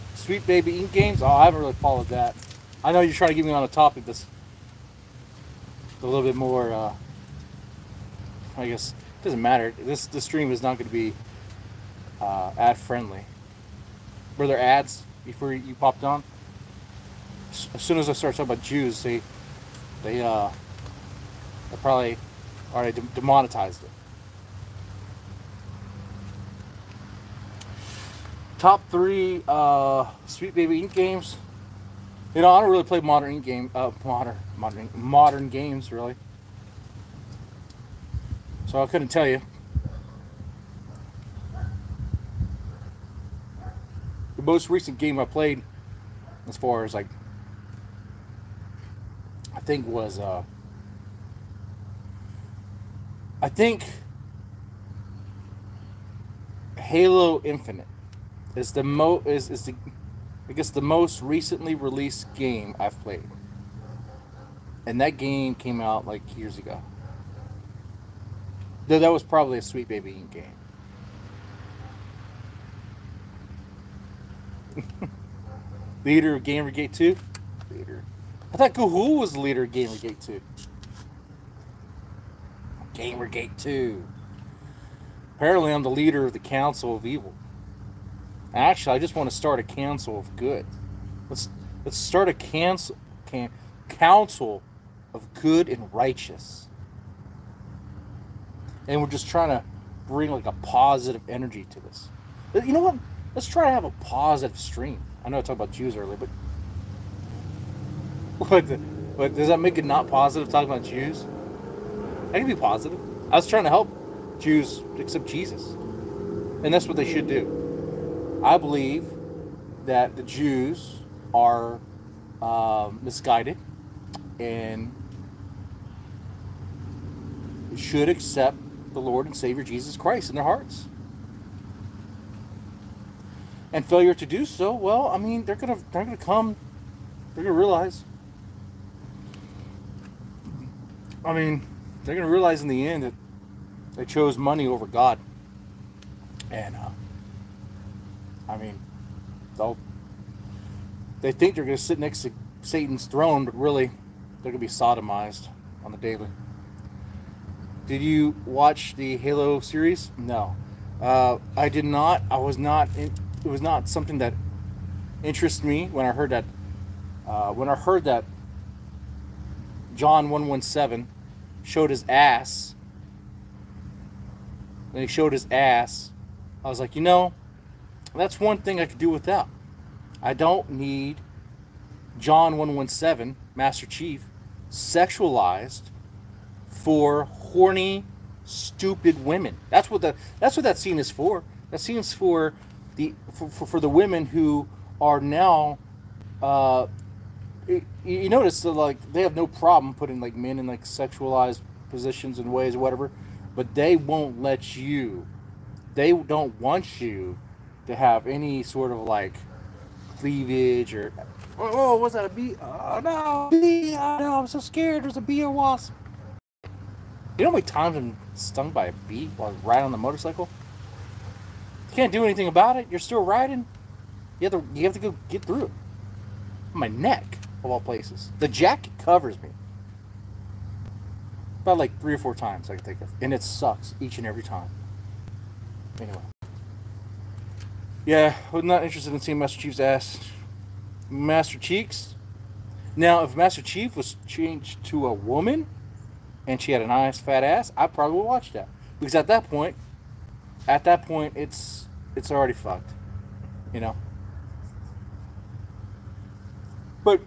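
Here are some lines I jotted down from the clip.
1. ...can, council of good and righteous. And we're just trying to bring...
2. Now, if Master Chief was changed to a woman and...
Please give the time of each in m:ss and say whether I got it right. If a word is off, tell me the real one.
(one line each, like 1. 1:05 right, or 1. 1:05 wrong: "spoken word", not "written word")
1. 1:33 right
2. 4:02 right.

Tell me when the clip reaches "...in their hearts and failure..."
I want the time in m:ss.
2:10.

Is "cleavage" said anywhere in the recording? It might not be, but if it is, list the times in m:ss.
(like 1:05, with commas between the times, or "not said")
3:30.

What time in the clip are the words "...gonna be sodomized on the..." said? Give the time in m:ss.
2:34.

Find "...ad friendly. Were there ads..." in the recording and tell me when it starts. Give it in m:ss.
0:12.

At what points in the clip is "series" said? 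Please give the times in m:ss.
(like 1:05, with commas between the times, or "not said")
2:39.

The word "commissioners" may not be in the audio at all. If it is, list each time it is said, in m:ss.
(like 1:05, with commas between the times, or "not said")
not said.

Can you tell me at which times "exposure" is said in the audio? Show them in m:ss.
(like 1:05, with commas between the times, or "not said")
not said.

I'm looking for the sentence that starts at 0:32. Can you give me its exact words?
You know, I don't really play modern game, uh, modern, modern, modern games really.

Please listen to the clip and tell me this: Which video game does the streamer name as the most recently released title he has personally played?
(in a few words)
Halo Infinite.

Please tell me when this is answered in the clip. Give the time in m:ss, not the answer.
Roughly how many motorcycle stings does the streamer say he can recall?
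3:52.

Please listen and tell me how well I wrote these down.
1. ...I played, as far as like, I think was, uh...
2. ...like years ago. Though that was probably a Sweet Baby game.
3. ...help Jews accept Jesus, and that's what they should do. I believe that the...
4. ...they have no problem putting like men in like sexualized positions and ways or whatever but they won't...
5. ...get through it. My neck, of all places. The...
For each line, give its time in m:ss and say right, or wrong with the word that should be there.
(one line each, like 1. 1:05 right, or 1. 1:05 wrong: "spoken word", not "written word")
1. 0:45 right
2. 1:06 right
3. 1:53 right
4. 3:19 right
5. 3:45 right.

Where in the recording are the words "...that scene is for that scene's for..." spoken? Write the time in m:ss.
3:10.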